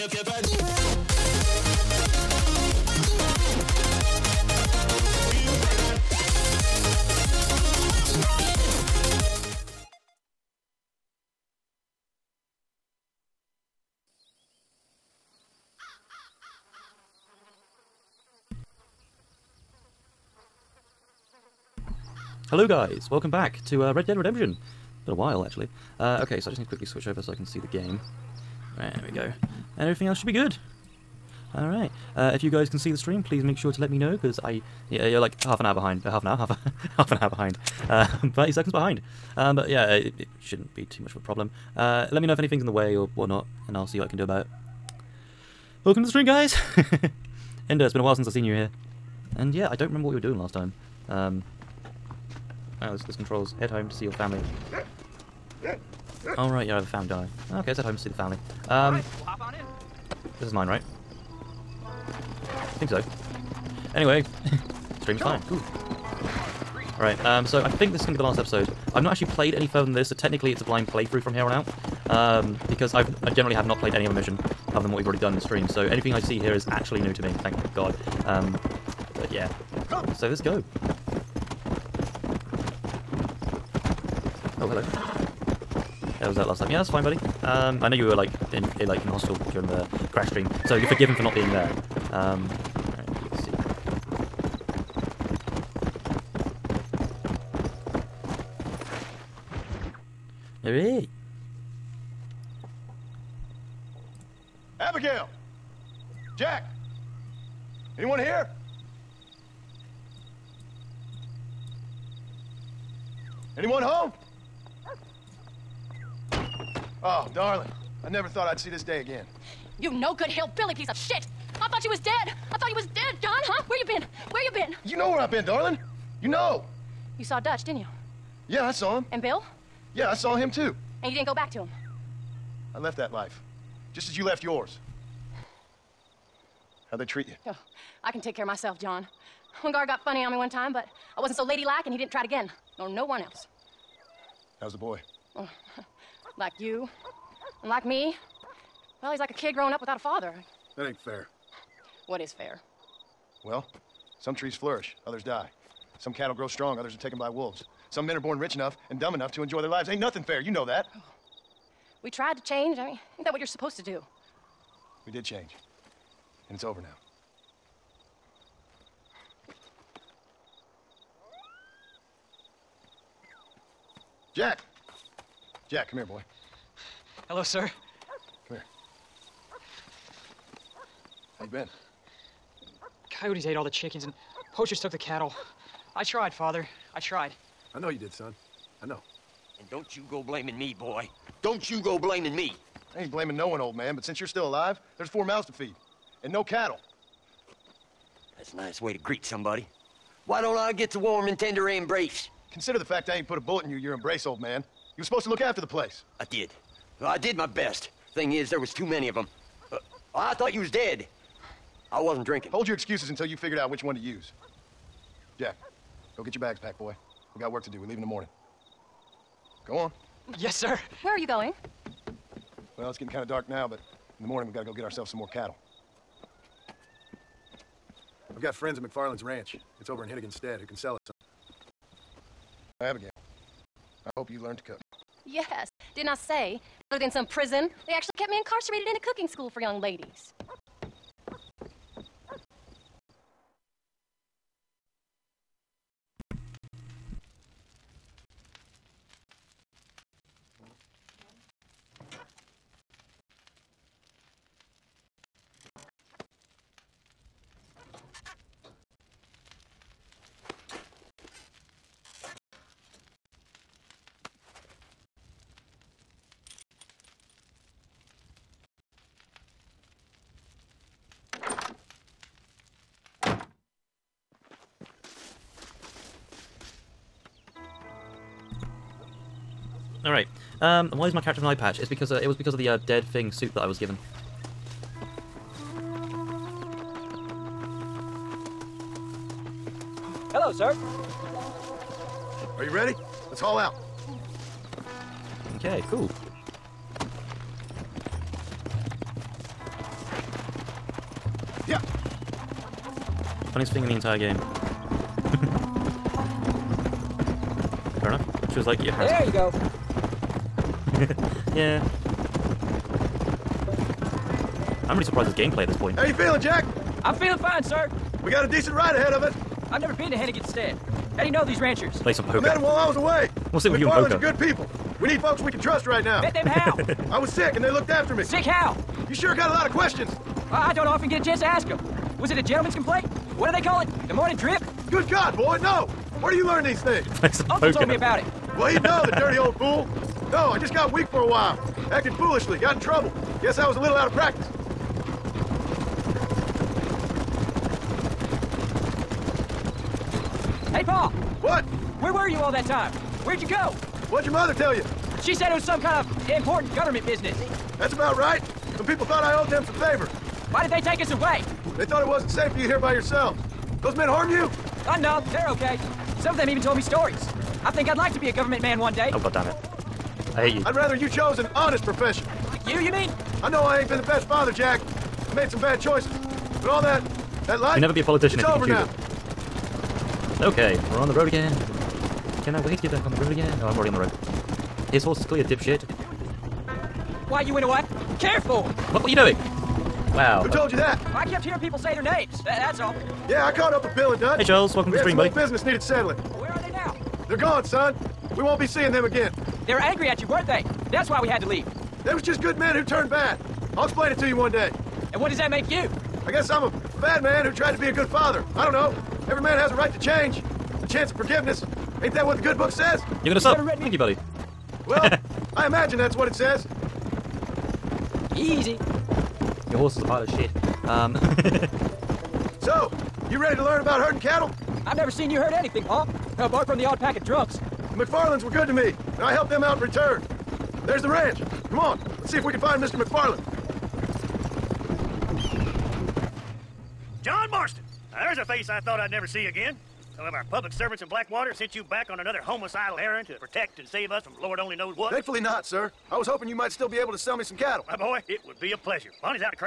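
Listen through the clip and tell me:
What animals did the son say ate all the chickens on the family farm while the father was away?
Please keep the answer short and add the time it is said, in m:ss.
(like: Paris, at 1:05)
Coyotes, at 3:03.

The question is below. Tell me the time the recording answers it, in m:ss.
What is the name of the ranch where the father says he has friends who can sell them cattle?
3:48.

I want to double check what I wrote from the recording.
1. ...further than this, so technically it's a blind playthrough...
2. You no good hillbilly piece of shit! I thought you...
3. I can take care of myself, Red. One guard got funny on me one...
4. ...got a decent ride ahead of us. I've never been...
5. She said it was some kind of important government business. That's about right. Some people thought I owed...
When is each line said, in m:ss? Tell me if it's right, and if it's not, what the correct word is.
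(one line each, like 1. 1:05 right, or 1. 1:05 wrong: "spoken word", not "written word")
1. 1:09 right
2. 1:59 right
3. 2:18 wrong: "John", not "Red"
4. 5:18 right
5. 5:55 right.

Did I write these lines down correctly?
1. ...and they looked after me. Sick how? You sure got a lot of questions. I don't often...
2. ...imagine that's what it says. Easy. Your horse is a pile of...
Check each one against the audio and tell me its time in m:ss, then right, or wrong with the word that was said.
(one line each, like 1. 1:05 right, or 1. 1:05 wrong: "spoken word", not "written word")
1. 5:27 right
2. 6:55 right.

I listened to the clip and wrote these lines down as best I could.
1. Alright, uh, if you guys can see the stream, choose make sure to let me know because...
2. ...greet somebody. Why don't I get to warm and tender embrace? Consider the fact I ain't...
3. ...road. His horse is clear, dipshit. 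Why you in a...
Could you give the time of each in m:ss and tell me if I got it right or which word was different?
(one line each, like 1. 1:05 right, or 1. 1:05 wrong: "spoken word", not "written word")
1. 0:31 wrong: "please", not "choose"
2. 3:18 right
3. 6:23 right.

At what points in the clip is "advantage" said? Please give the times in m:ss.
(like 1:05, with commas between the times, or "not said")
not said.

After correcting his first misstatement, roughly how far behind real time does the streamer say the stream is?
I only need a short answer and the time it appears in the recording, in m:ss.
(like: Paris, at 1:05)
30 seconds, at 0:38.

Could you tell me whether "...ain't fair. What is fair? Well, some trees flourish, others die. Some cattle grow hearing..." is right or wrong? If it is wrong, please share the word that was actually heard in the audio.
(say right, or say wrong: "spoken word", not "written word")
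wrong: "strong", not "hearing".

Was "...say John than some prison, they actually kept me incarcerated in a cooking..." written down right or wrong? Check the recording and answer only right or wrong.
wrong.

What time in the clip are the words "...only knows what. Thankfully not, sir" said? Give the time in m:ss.
7:24.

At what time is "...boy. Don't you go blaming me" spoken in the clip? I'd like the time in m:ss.
3:10.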